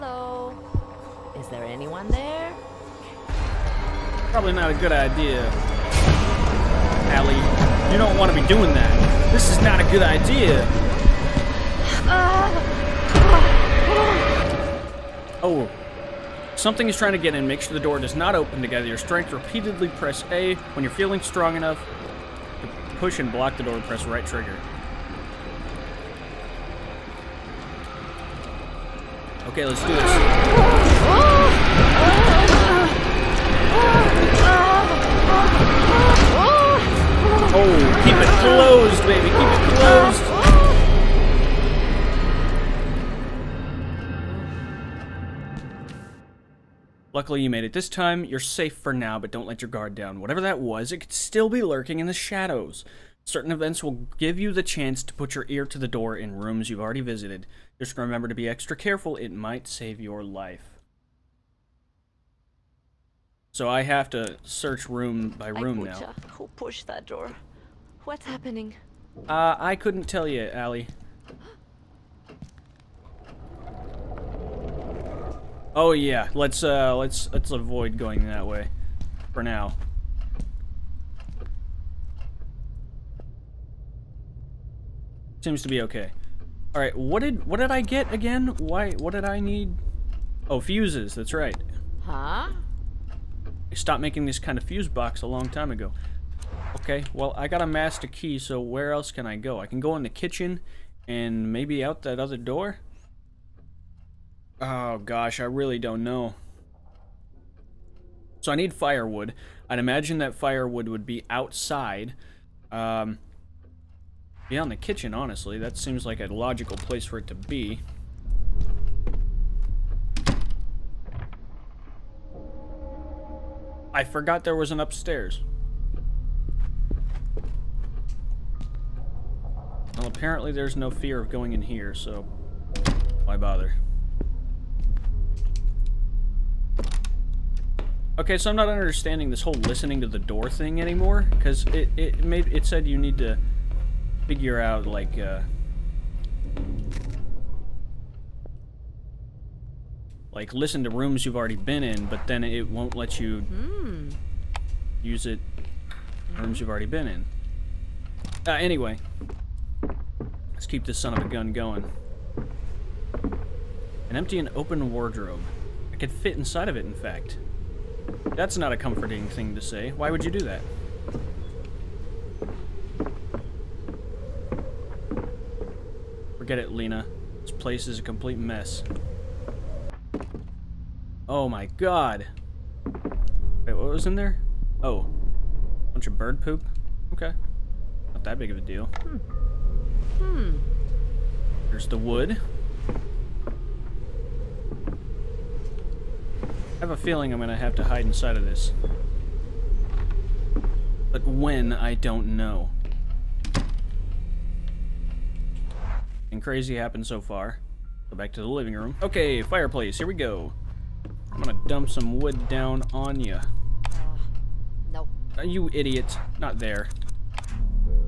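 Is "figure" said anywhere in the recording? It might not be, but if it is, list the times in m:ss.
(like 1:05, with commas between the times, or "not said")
2:24.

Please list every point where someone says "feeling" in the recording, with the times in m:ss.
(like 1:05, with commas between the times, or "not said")
0:20, 3:17.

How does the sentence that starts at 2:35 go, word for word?
use it rooms you've already been in.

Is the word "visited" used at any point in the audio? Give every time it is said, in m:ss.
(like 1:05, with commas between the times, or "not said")
0:57.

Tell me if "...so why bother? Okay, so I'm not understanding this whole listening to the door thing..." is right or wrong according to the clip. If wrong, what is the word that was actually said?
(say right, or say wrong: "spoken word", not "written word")
right.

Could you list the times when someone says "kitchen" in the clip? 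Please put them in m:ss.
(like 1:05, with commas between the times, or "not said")
1:40, 1:54.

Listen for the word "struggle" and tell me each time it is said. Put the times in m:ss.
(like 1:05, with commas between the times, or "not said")
not said.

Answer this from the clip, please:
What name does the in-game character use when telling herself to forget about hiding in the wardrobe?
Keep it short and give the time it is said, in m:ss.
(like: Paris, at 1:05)
Lena, at 2:56.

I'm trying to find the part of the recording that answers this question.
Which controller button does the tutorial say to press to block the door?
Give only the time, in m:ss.
0:24.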